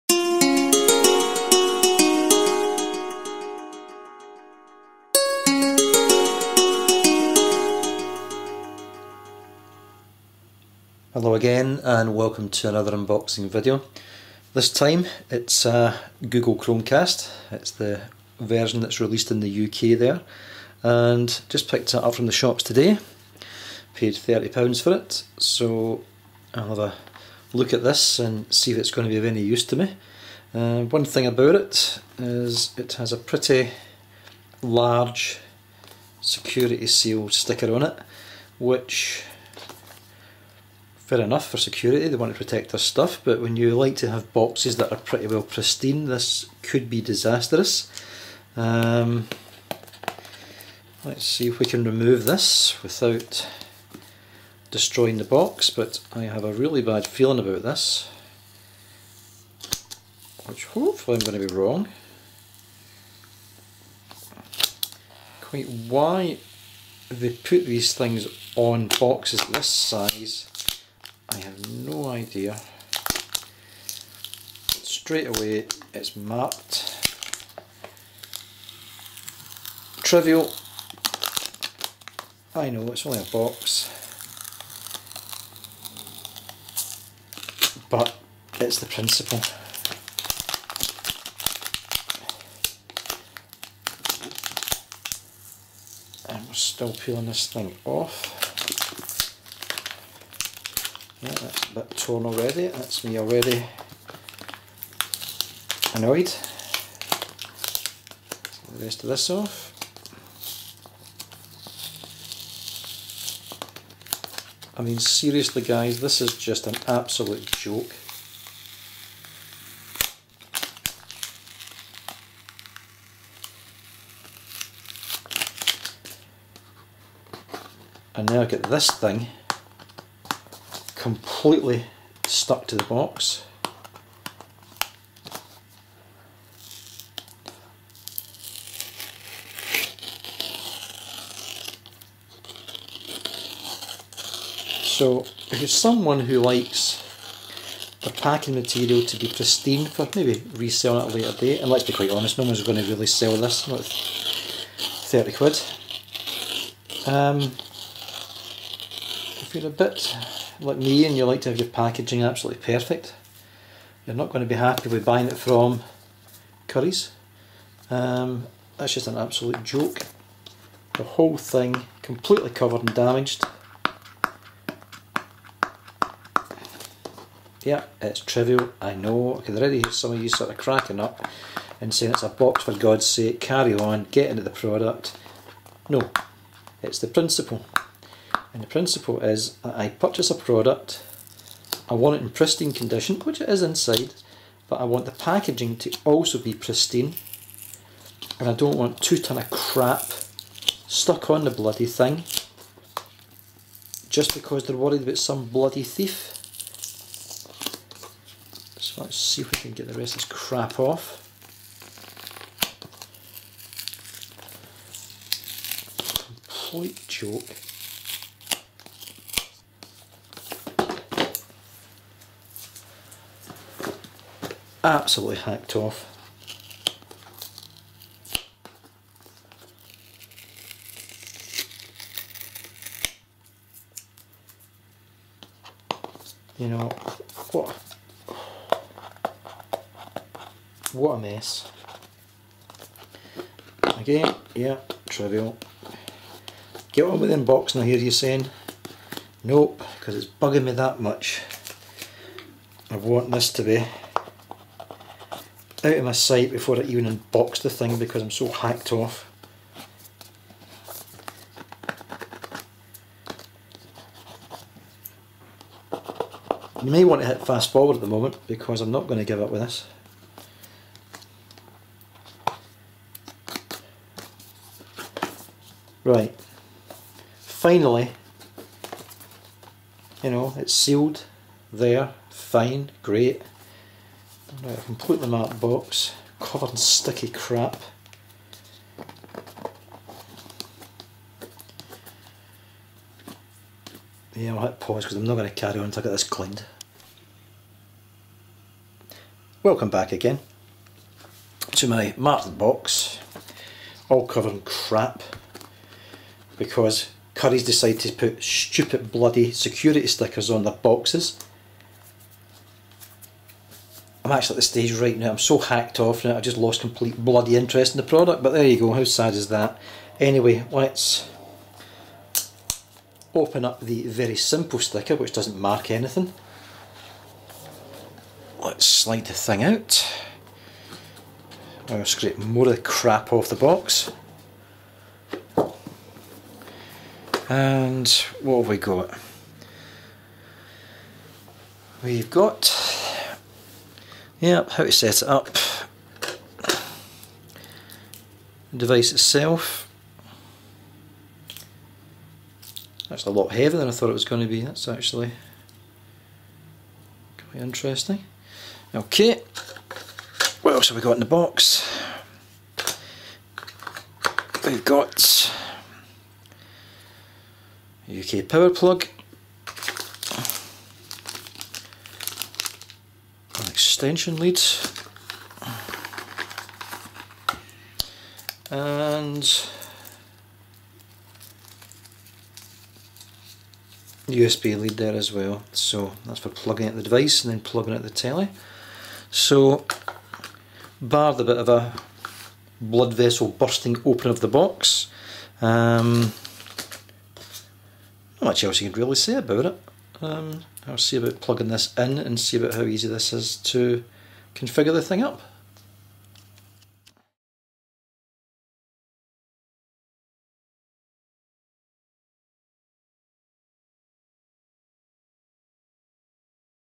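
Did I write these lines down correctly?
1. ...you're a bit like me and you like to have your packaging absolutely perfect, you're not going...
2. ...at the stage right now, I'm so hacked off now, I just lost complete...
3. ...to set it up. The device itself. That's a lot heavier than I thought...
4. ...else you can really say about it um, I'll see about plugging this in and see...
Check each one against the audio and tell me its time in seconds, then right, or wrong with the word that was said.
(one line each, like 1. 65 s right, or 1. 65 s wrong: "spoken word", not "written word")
1. 159 s right
2. 314 s right
3. 344 s right
4. 398 s right.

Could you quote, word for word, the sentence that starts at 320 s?
Anyway, let's open up the very simple sticker, which doesn't mark anything.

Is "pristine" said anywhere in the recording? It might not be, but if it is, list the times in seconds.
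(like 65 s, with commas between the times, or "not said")
45 s, 149 s, 192 s, 196 s.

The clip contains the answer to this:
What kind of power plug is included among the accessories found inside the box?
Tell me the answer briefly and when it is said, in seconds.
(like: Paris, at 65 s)
UK power plug, at 368 s.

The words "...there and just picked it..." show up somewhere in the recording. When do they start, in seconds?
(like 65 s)
19 s.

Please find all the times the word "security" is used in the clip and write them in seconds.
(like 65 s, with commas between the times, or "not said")
36 s, 41 s, 309 s.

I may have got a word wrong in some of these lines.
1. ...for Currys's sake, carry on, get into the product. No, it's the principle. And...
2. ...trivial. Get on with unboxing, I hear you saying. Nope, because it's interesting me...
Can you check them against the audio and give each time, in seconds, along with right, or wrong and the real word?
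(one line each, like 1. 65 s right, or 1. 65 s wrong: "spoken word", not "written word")
1. 182 s wrong: "God", not "Currys"
2. 245 s wrong: "bugging", not "interesting".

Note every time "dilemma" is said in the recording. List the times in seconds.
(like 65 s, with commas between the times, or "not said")
not said.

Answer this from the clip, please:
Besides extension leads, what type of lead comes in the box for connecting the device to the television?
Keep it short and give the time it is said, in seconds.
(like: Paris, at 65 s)
USB lead, at 384 s.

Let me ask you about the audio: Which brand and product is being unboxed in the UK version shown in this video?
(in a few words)
Google Chromecast.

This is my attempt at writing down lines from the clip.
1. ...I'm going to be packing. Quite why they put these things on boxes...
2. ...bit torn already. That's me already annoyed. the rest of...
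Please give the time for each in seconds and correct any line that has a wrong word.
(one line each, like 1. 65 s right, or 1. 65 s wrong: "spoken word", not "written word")
1. 61 s wrong: "wrong", not "packing"
2. 101 s right.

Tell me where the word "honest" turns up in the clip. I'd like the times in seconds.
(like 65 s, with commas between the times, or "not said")
152 s.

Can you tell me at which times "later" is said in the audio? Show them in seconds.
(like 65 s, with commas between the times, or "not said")
151 s.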